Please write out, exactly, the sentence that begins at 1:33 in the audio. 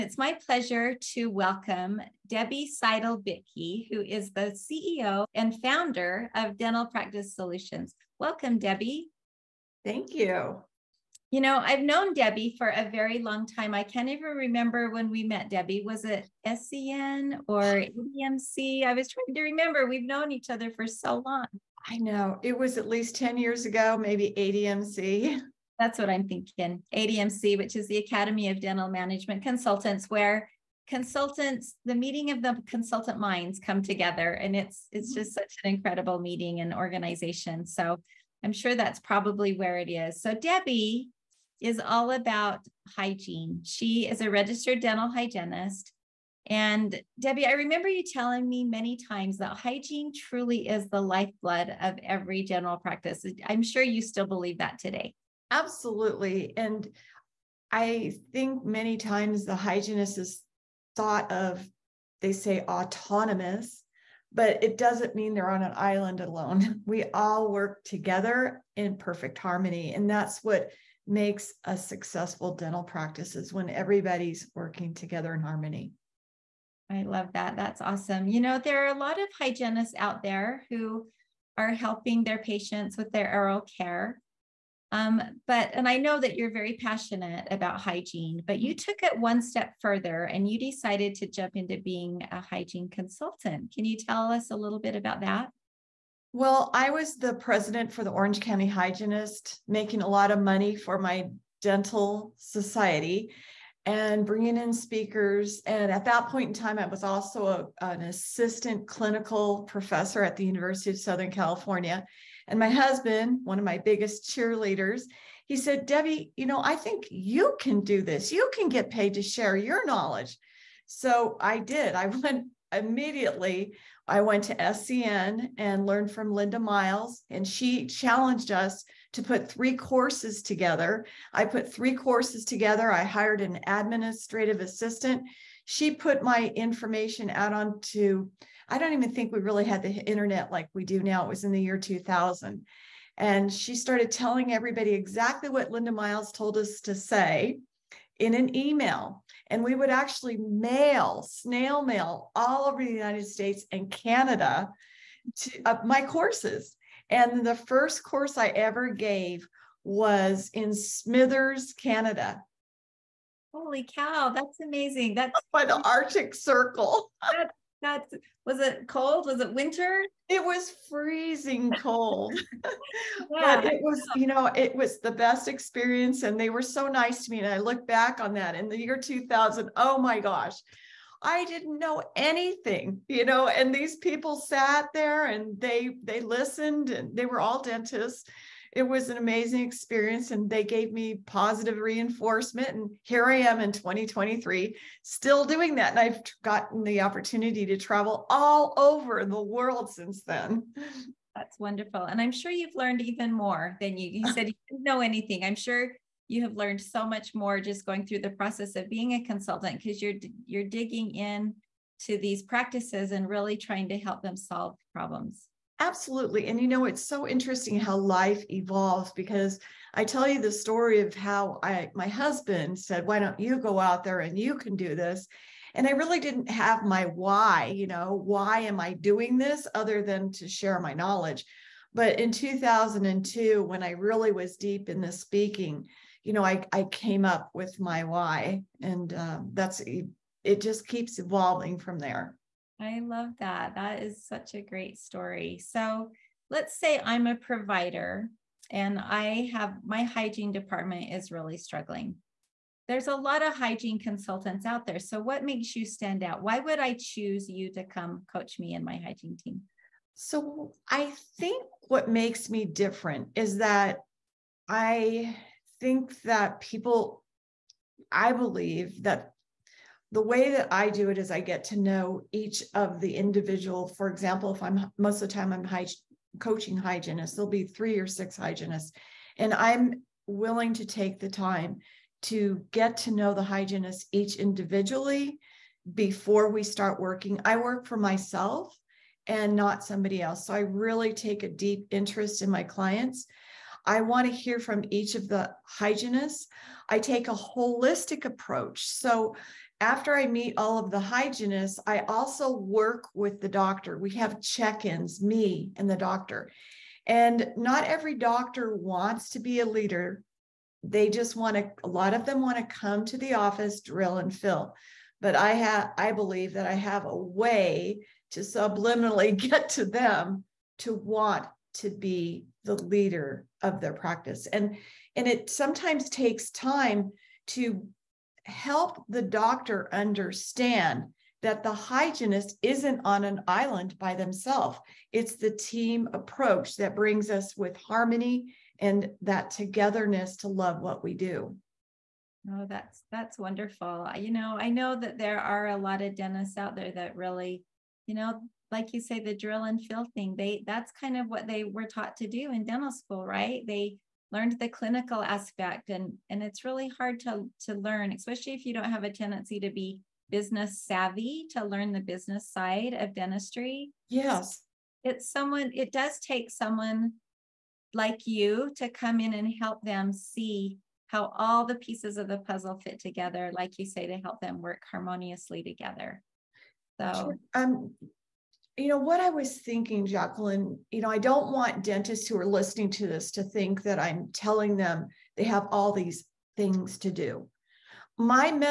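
Can you tell us a little bit about that?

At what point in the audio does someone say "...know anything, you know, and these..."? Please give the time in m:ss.
3:01.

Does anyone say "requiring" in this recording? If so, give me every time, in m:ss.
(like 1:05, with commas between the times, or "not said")
not said.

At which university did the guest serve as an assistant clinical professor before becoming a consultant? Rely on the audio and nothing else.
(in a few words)
University of Southern California.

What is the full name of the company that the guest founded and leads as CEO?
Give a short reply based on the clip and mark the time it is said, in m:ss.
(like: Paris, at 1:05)
Dental Practice Solutions, at 0:06.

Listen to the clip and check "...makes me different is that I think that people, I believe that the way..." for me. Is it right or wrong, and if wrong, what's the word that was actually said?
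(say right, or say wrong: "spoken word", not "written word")
right.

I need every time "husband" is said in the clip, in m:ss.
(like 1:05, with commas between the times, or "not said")
1:52, 3:42.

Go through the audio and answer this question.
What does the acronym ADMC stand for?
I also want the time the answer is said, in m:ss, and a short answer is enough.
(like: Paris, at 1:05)
Academy of Dental Management Consultants, at 0:27.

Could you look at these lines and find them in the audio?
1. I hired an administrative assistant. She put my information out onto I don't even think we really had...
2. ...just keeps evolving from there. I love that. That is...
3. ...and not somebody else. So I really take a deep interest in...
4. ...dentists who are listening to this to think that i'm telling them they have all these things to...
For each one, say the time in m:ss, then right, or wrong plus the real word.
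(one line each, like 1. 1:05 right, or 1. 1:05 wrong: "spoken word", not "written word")
1. 2:12 right
2. 4:00 right
3. 4:49 right
4. 6:21 right.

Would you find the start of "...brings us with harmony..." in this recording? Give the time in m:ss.
5:36.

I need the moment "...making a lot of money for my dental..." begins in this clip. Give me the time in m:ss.
1:39.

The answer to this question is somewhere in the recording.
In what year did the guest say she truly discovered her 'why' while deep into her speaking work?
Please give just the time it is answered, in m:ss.
3:52.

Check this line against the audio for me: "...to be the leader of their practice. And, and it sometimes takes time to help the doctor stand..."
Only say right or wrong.
wrong.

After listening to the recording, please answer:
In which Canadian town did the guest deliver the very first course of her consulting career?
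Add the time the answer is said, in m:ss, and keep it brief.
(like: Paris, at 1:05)
Smithers, at 2:40.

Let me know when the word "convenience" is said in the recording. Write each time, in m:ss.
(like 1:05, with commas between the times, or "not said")
not said.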